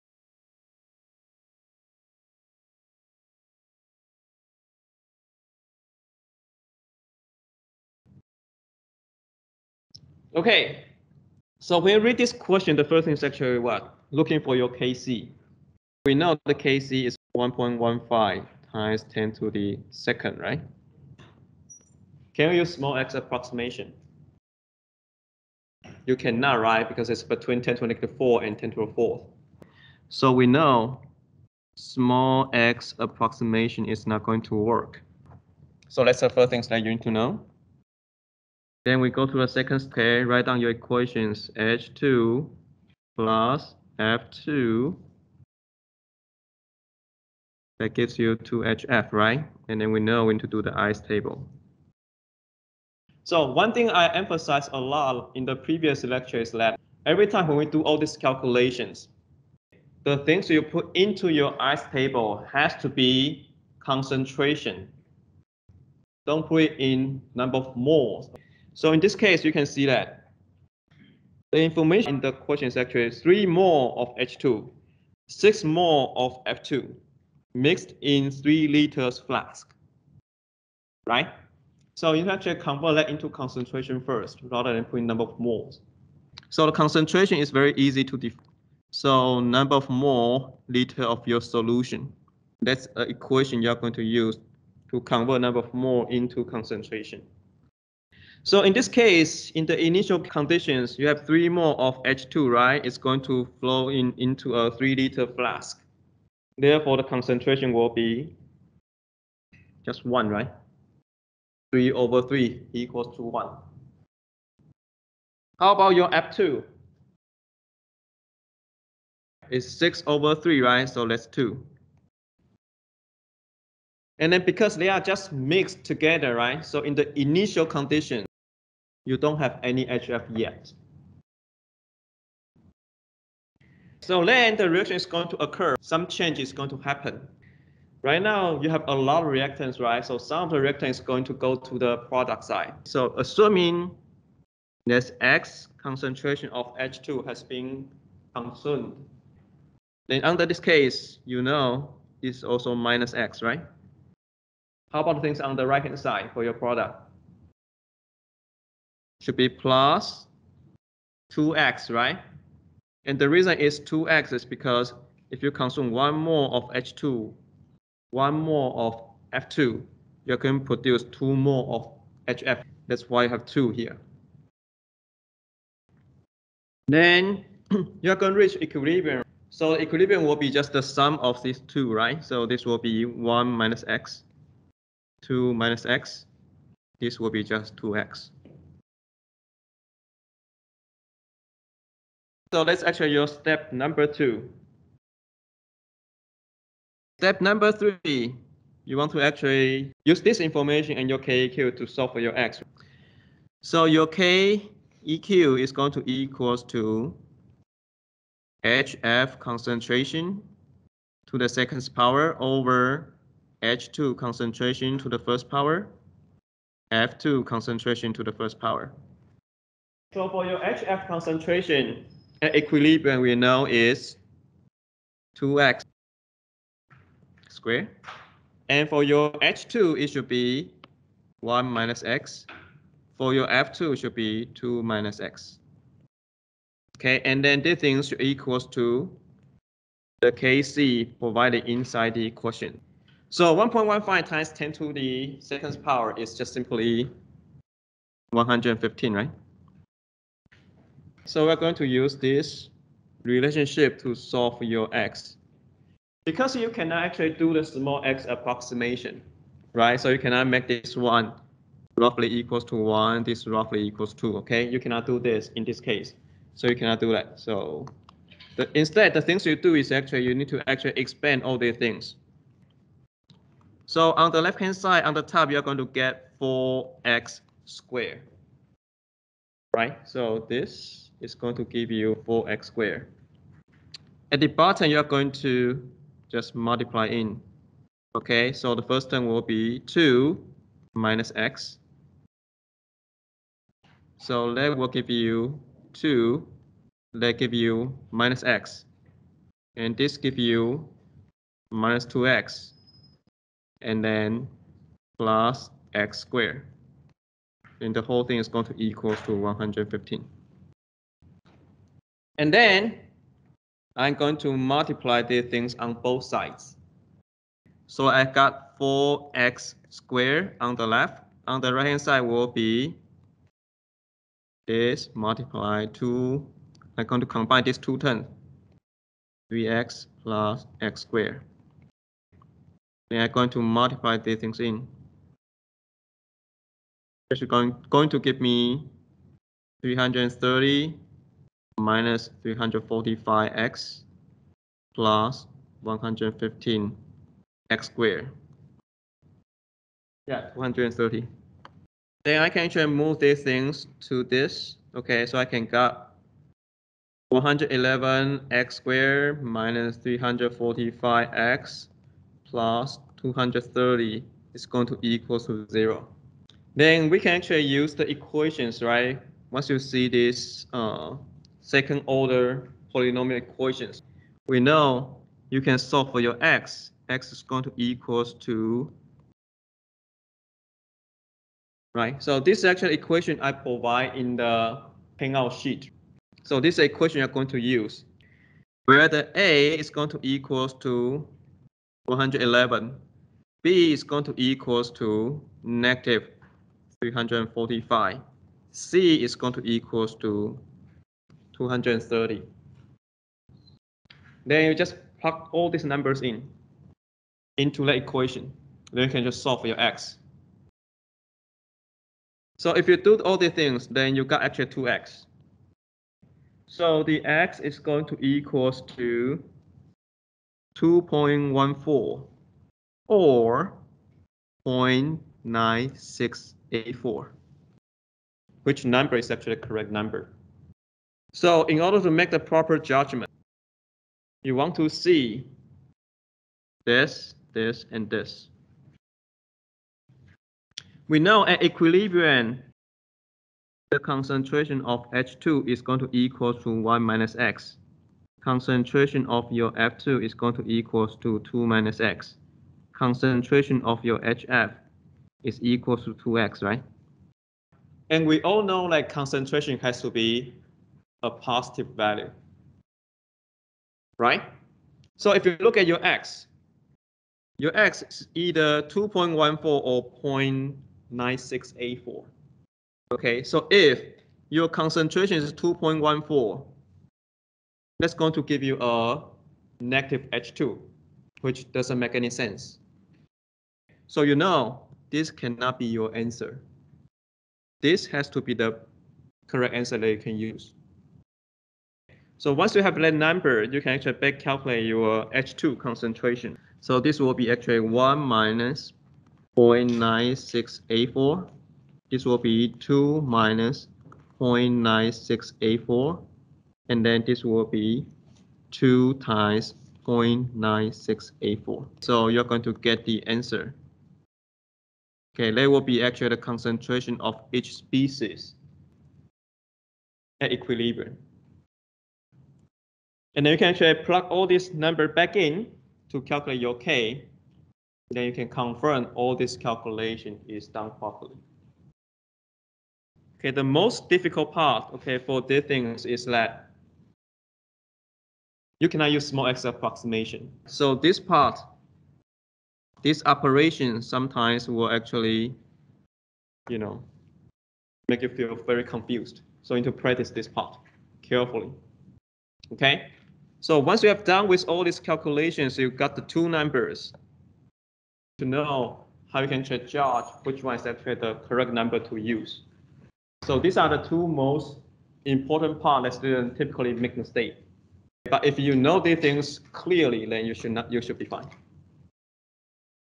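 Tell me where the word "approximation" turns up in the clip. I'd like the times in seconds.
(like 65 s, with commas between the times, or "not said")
23 s, 32 s, 258 s, 539 s.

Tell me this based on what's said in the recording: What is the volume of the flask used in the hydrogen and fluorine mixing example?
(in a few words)
3 liters.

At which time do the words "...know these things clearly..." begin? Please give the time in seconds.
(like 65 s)
568 s.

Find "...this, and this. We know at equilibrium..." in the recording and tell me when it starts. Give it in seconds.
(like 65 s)
437 s.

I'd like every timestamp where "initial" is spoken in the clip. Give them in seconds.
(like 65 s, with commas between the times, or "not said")
99 s, 127 s.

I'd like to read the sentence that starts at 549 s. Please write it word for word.
So you need to practice this part carefully.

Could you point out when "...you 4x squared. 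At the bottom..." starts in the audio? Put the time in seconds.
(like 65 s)
281 s.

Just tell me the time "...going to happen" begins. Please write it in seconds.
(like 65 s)
136 s.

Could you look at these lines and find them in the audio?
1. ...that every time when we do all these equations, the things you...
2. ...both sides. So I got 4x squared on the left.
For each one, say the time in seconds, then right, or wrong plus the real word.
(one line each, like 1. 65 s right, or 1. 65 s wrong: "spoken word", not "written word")
1. 56 s wrong: "calculations", not "equations"
2. 316 s right.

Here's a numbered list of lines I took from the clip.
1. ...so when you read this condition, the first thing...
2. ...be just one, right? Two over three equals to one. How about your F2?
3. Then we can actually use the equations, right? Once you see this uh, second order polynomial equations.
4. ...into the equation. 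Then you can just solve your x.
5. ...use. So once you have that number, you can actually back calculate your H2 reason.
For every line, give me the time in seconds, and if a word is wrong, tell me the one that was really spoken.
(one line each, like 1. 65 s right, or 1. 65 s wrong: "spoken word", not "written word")
1. 11 s wrong: "question", not "condition"
2. 107 s wrong: "Three", not "Two"
3. 366 s right
4. 407 s right
5. 490 s wrong: "concentration", not "reason".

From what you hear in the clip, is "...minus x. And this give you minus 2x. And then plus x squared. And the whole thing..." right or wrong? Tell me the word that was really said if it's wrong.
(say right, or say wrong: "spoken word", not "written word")
right.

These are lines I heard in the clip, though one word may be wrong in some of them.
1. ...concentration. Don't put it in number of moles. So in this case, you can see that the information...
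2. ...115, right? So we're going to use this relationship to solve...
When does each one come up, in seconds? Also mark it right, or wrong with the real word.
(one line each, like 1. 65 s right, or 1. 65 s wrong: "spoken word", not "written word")
1. 63 s right
2. 248 s right.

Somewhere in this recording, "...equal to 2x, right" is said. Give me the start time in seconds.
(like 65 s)
455 s.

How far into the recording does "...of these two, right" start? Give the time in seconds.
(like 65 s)
181 s.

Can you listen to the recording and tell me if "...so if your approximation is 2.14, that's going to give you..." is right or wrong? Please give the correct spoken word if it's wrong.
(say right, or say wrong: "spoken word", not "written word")
wrong: "concentration", not "approximation".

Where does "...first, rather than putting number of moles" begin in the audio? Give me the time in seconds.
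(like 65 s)
84 s.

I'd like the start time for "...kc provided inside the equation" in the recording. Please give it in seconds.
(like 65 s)
240 s.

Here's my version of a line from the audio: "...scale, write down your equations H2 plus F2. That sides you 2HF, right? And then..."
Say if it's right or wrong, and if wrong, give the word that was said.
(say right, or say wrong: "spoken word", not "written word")
wrong: "gives", not "sides".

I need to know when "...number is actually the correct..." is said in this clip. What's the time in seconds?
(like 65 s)
428 s.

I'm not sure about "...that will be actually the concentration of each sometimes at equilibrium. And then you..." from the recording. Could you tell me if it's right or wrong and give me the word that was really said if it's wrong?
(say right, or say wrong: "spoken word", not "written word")
wrong: "species", not "sometimes".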